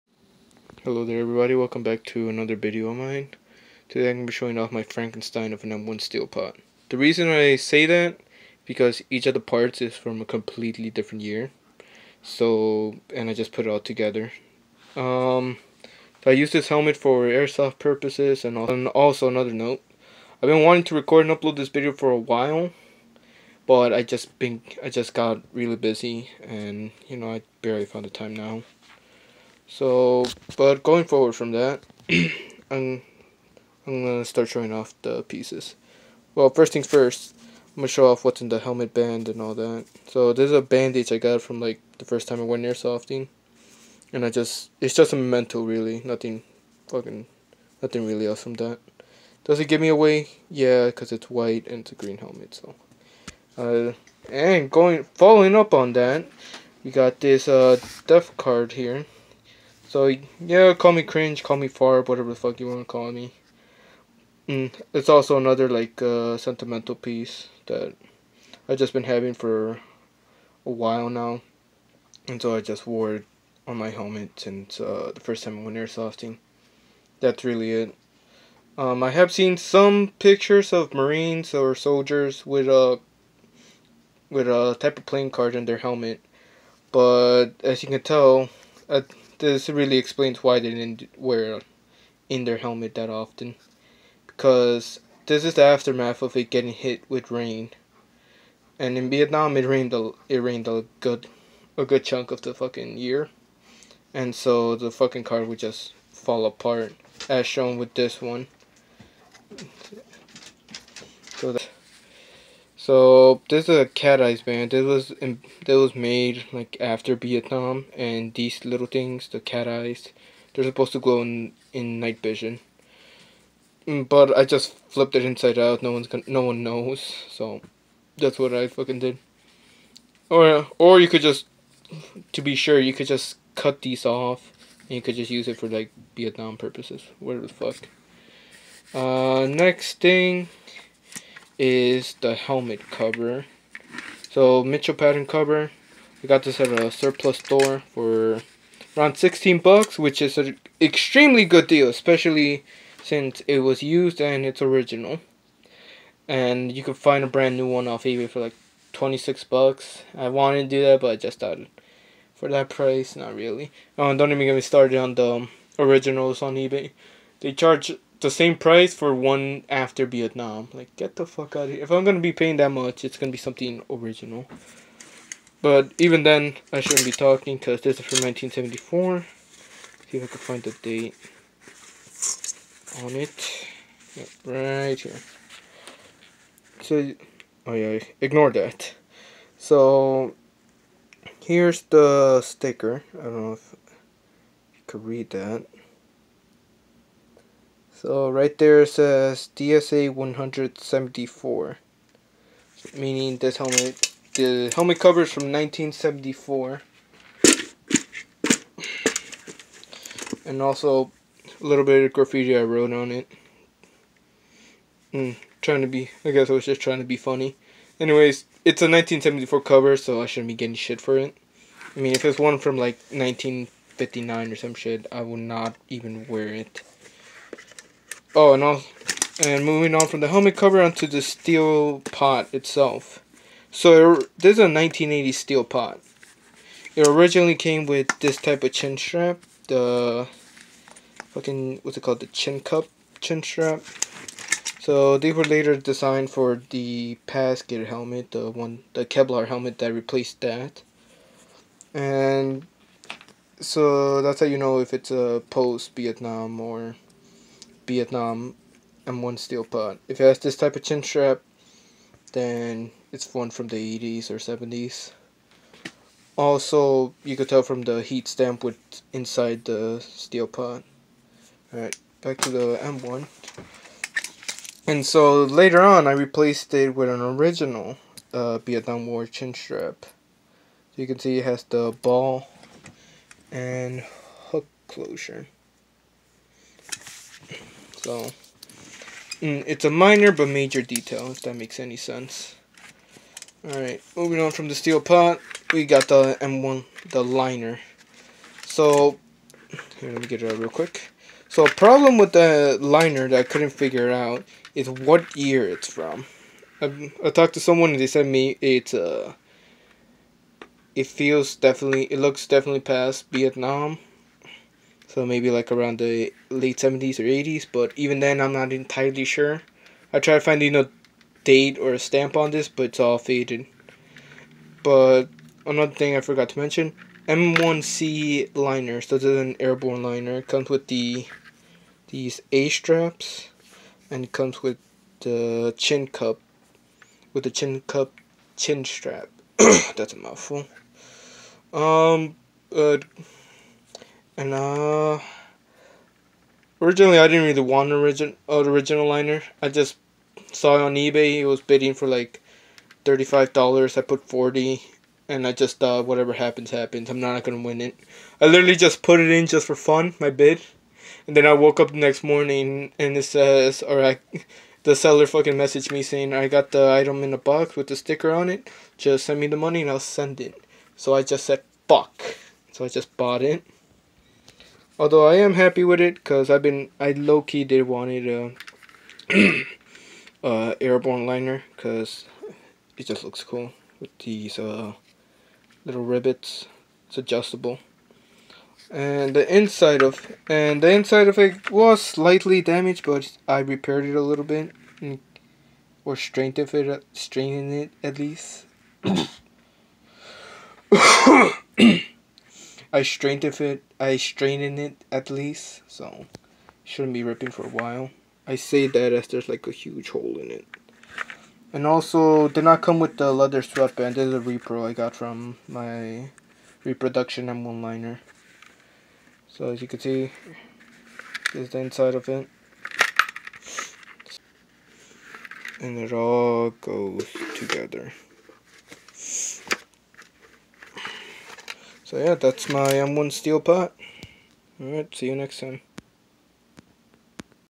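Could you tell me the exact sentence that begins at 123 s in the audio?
Mm, but I just flipped it inside out.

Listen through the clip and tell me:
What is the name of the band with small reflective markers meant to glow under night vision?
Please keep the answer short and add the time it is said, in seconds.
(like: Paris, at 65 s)
cat eyes band, at 113 s.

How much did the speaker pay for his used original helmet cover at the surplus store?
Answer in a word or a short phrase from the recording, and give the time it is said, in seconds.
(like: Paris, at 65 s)
$16, at 149 s.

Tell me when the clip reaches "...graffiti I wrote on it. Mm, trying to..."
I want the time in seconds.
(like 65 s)
212 s.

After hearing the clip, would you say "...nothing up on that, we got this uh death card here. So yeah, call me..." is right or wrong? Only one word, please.
wrong.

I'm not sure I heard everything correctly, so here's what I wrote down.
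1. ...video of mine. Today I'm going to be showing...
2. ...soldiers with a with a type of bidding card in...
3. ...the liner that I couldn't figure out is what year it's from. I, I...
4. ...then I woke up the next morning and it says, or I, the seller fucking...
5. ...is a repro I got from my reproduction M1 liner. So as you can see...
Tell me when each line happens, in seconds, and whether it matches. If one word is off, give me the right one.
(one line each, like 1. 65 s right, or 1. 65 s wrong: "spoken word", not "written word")
1. 2 s right
2. 81 s wrong: "playing", not "bidding"
3. 302 s right
4. 361 s right
5. 414 s right.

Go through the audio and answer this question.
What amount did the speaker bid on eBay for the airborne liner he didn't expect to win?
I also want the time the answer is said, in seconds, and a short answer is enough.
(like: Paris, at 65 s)
$40, at 354 s.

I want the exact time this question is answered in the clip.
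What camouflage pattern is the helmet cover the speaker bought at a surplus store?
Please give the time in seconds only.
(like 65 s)
144 s.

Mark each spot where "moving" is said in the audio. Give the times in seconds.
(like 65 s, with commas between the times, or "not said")
229 s, 294 s.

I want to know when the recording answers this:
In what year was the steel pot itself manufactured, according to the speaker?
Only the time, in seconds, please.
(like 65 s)
234 s.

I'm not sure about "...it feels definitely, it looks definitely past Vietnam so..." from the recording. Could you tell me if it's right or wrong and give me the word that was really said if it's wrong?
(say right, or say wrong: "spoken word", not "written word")
right.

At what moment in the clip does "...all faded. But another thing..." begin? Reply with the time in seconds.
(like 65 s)
323 s.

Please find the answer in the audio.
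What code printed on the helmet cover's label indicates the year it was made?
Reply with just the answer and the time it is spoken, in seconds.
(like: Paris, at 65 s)
DSA 174, at 199 s.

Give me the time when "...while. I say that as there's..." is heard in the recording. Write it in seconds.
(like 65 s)
407 s.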